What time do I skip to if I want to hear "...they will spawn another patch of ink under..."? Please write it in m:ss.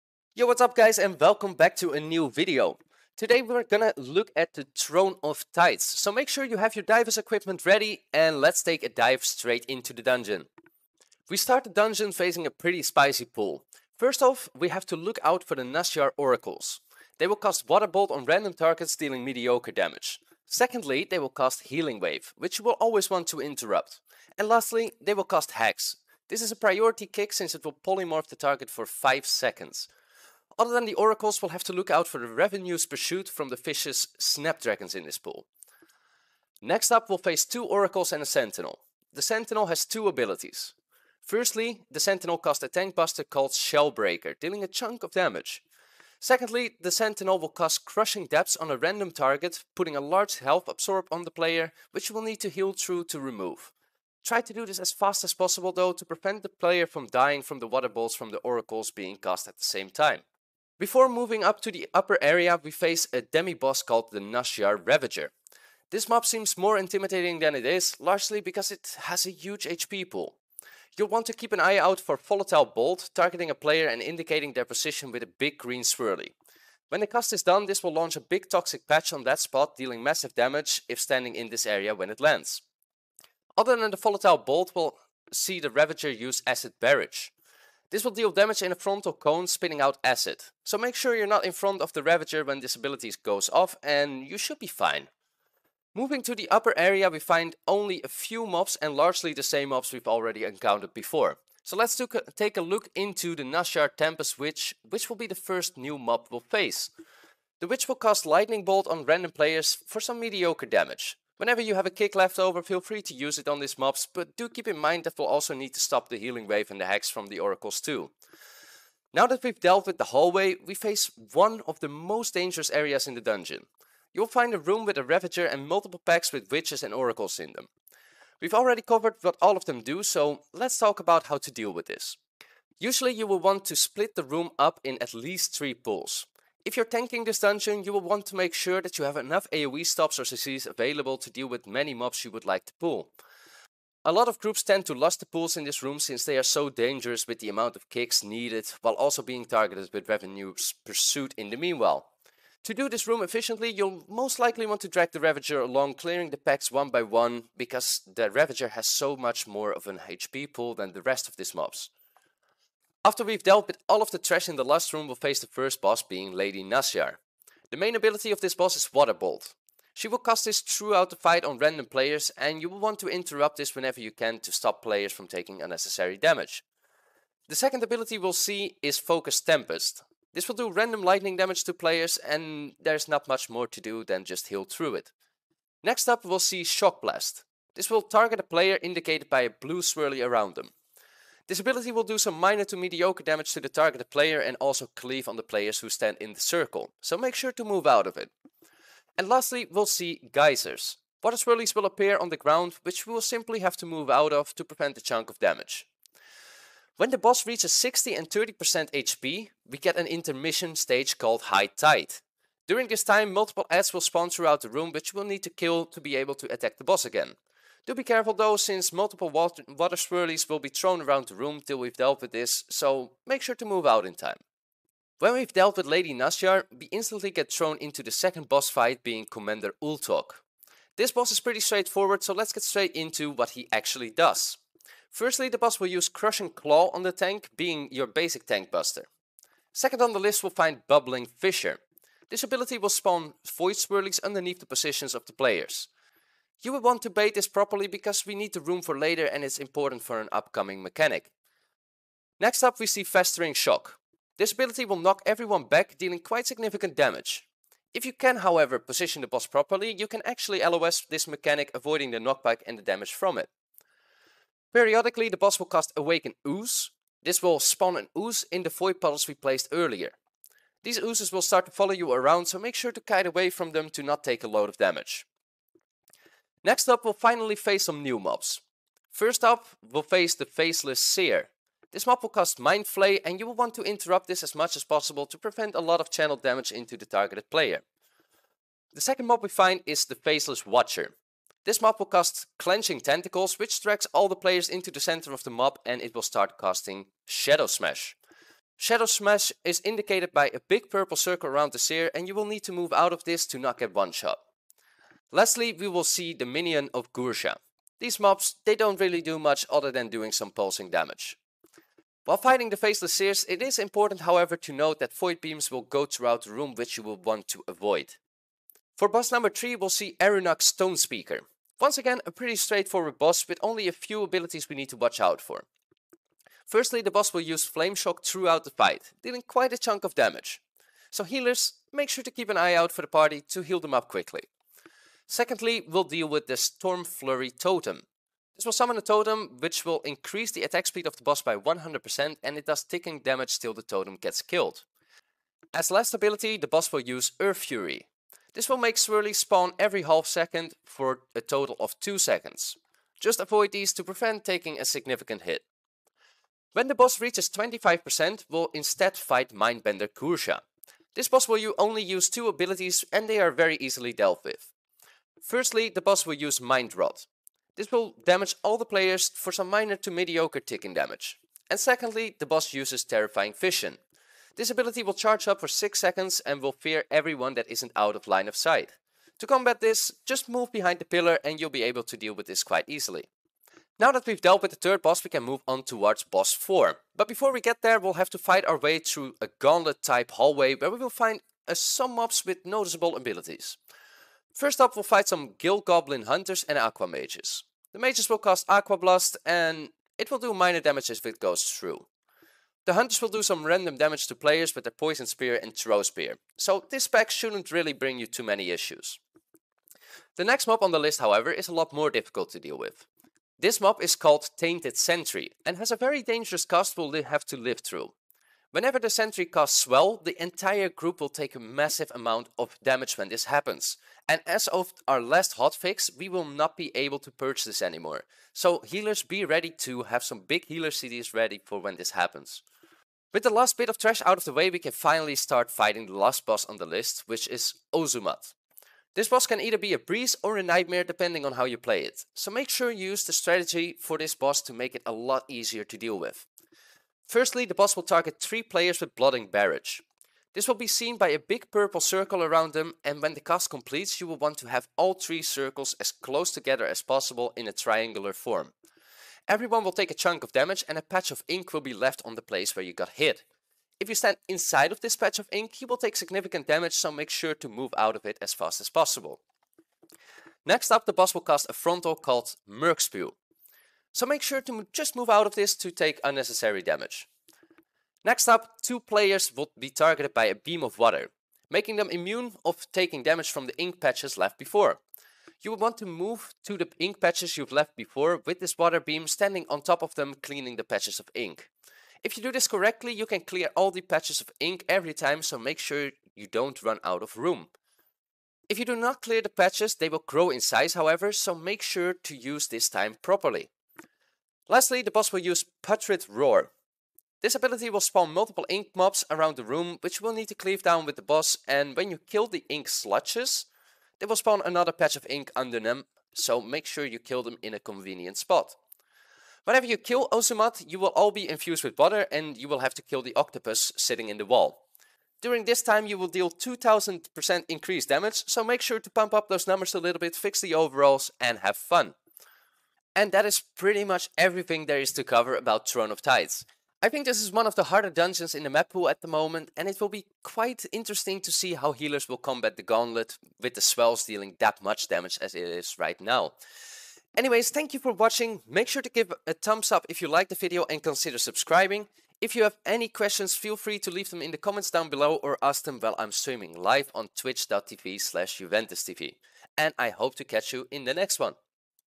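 8:34.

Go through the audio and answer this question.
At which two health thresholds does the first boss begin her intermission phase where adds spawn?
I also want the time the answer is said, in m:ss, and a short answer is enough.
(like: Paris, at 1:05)
60 and 30%, at 3:27.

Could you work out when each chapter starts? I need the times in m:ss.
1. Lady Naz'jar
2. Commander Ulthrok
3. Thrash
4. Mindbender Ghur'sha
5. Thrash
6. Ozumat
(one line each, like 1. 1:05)
1. 2:43
2. 3:44
3. 4:34
4. 5:20
5. 6:27
6. 7:18.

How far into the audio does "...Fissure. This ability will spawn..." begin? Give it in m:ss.
4:01.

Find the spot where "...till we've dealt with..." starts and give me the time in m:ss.
3:41.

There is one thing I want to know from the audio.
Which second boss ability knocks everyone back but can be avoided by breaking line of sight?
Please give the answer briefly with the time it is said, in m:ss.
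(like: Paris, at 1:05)
Festering Shock, at 4:13.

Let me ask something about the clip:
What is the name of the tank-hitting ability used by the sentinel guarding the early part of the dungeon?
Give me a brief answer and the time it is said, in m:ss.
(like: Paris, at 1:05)
Shellbreaker, at 0:43.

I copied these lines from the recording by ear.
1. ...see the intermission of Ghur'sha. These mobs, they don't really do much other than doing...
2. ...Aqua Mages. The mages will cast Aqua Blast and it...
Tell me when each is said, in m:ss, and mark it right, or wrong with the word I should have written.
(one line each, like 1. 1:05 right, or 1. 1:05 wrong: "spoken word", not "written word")
1. 5:06 wrong: "minion", not "intermission"
2. 6:36 right.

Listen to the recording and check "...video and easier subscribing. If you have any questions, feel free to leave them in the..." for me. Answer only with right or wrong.
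wrong.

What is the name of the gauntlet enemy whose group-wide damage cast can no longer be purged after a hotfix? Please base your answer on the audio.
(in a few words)
Tainted Sentry.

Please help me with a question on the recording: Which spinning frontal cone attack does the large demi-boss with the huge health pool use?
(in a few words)
Acid Barrage.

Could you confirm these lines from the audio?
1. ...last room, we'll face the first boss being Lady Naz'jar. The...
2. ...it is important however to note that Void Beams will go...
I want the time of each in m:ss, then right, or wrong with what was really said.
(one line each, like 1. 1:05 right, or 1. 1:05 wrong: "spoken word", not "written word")
1. 2:44 right
2. 5:13 right.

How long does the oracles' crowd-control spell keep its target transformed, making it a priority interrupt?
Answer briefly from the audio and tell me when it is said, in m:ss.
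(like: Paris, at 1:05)
5 seconds, at 0:28.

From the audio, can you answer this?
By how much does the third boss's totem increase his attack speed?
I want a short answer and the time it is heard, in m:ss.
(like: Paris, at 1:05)
100%, at 5:41.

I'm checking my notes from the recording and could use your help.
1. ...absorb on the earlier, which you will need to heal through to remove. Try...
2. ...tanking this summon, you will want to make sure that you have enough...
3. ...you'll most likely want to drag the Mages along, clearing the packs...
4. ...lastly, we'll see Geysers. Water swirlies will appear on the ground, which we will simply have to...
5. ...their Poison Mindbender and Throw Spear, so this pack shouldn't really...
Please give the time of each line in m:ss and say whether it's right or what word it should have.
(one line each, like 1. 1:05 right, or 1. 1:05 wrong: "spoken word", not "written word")
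1. 0:50 wrong: "player", not "earlier"
2. 2:16 wrong: "dungeon", not "summon"
3. 2:33 wrong: "Ravager", not "Mages"
4. 3:19 right
5. 6:44 wrong: "Spear", not "Mindbender".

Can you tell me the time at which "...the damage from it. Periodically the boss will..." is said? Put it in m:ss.
4:22.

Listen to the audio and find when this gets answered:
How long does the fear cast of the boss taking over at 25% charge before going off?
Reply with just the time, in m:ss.
6:15.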